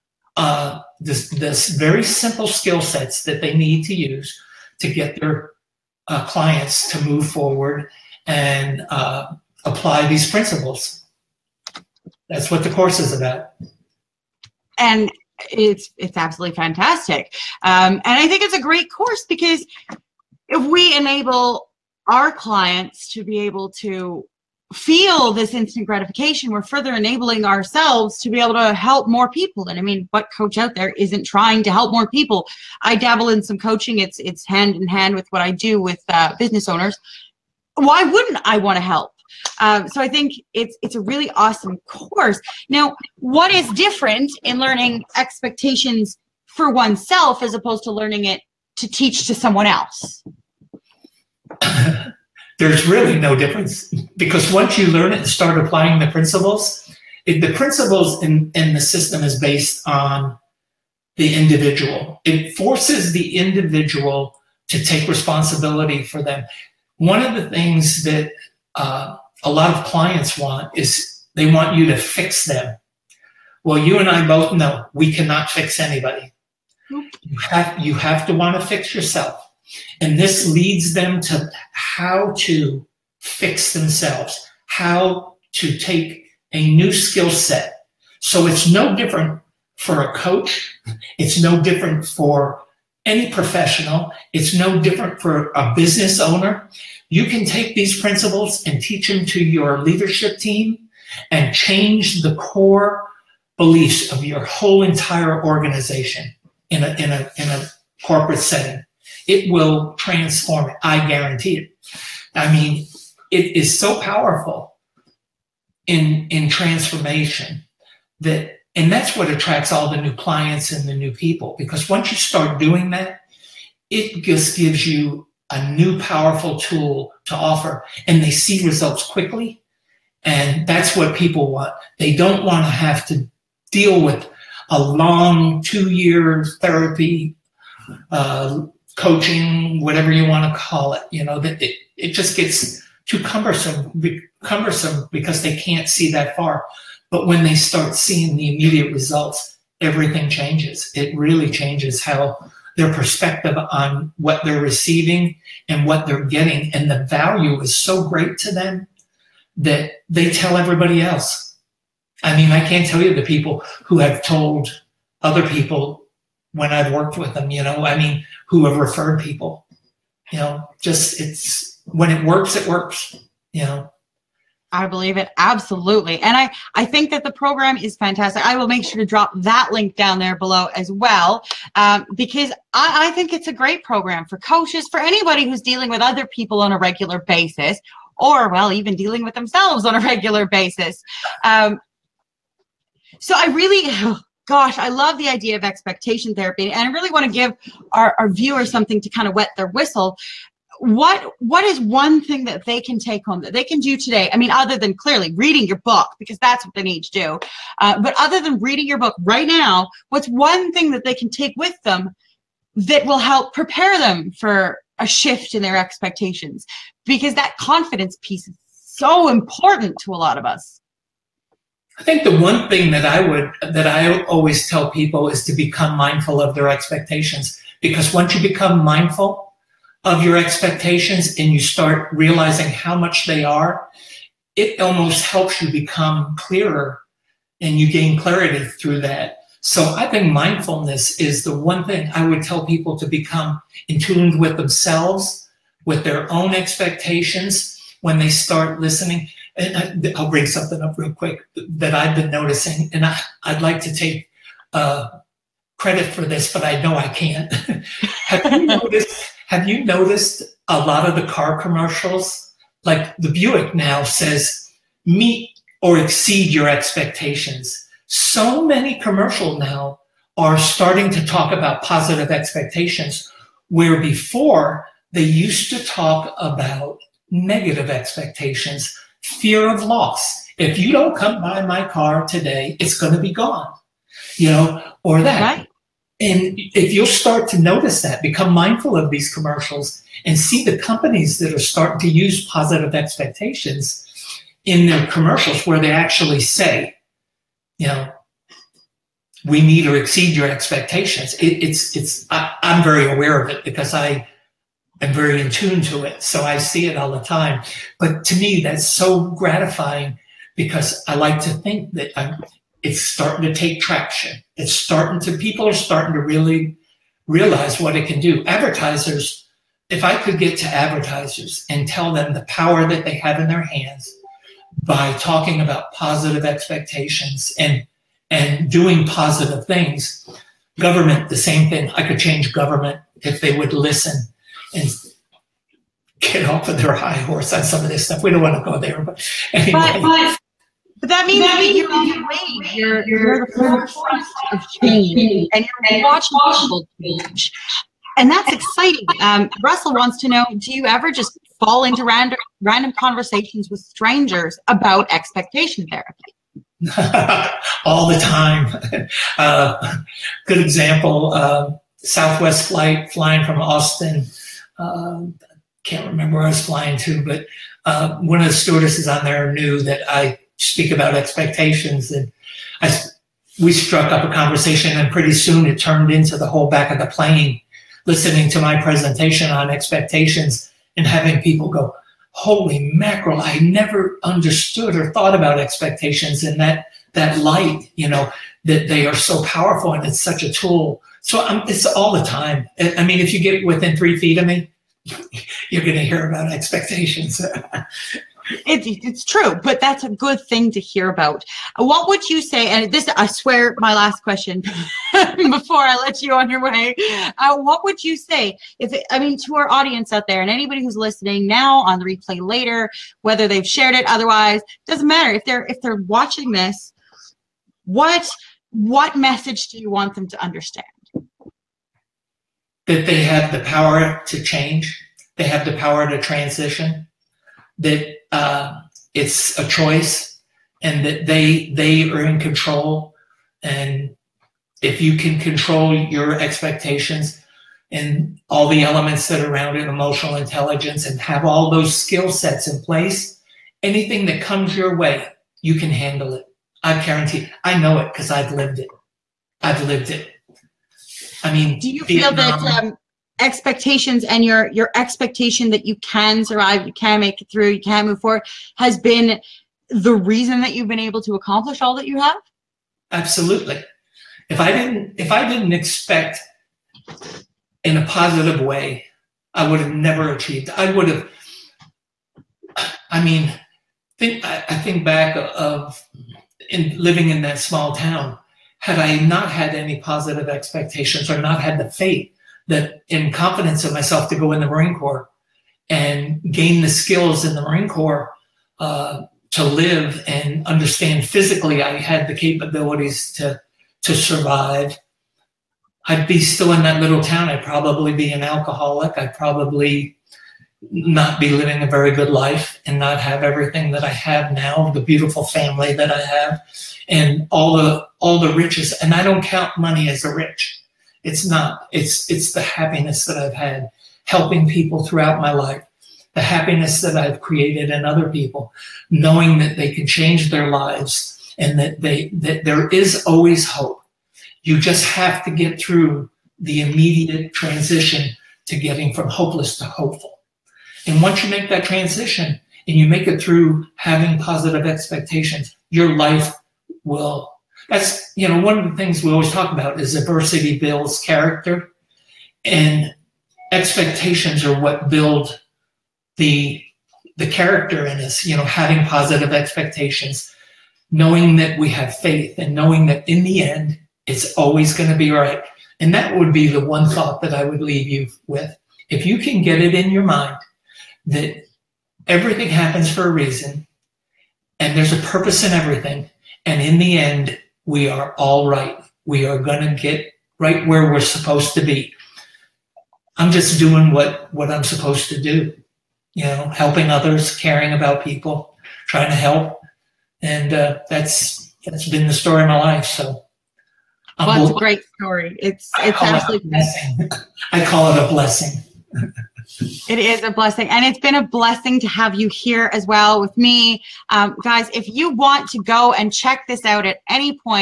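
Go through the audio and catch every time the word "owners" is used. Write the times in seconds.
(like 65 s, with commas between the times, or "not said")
36 s, 96 s.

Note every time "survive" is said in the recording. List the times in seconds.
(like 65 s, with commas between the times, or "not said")
456 s, 494 s.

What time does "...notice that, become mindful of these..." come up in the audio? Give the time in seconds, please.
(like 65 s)
287 s.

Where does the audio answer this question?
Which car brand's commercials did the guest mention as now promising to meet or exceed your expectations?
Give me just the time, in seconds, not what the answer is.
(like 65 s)
263 s.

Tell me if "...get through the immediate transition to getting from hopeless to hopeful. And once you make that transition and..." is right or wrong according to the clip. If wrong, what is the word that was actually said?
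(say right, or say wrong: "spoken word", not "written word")
right.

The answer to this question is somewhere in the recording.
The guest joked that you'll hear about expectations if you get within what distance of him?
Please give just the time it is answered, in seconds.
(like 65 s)
393 s.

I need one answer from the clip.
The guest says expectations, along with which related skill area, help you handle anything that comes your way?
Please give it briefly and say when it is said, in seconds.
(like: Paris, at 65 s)
emotional intelligence, at 439 s.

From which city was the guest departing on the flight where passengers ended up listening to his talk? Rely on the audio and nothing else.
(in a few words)
Austin.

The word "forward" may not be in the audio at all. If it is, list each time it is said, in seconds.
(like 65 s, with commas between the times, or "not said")
7 s, 458 s.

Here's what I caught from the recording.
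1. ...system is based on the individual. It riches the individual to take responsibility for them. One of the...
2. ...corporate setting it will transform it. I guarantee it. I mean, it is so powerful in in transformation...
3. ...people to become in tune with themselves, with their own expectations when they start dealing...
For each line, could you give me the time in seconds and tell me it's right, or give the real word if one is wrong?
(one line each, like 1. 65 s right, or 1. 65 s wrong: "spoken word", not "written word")
1. 58 s wrong: "forces", not "riches"
2. 108 s right
3. 242 s wrong: "listening", not "dealing".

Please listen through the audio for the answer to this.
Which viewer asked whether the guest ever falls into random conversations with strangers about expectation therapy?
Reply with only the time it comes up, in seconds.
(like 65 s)
349 s.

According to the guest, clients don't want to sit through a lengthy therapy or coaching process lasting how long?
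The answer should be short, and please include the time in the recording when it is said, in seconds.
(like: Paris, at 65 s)
2 years, at 135 s.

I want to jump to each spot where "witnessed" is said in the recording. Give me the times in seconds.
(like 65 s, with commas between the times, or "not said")
not said.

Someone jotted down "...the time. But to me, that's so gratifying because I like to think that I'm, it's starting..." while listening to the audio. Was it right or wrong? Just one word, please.
right.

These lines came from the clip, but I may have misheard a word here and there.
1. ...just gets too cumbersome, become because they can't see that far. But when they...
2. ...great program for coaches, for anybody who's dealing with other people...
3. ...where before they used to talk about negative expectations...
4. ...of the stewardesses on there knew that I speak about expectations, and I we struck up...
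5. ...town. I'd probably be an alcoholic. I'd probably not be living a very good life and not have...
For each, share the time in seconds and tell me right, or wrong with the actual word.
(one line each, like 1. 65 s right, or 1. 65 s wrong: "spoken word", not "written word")
1. 142 s wrong: "cumbersome", not "become"
2. 183 s right
3. 273 s right
4. 368 s right
5. 497 s right.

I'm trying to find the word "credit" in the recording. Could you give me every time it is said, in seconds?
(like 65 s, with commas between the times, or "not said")
255 s.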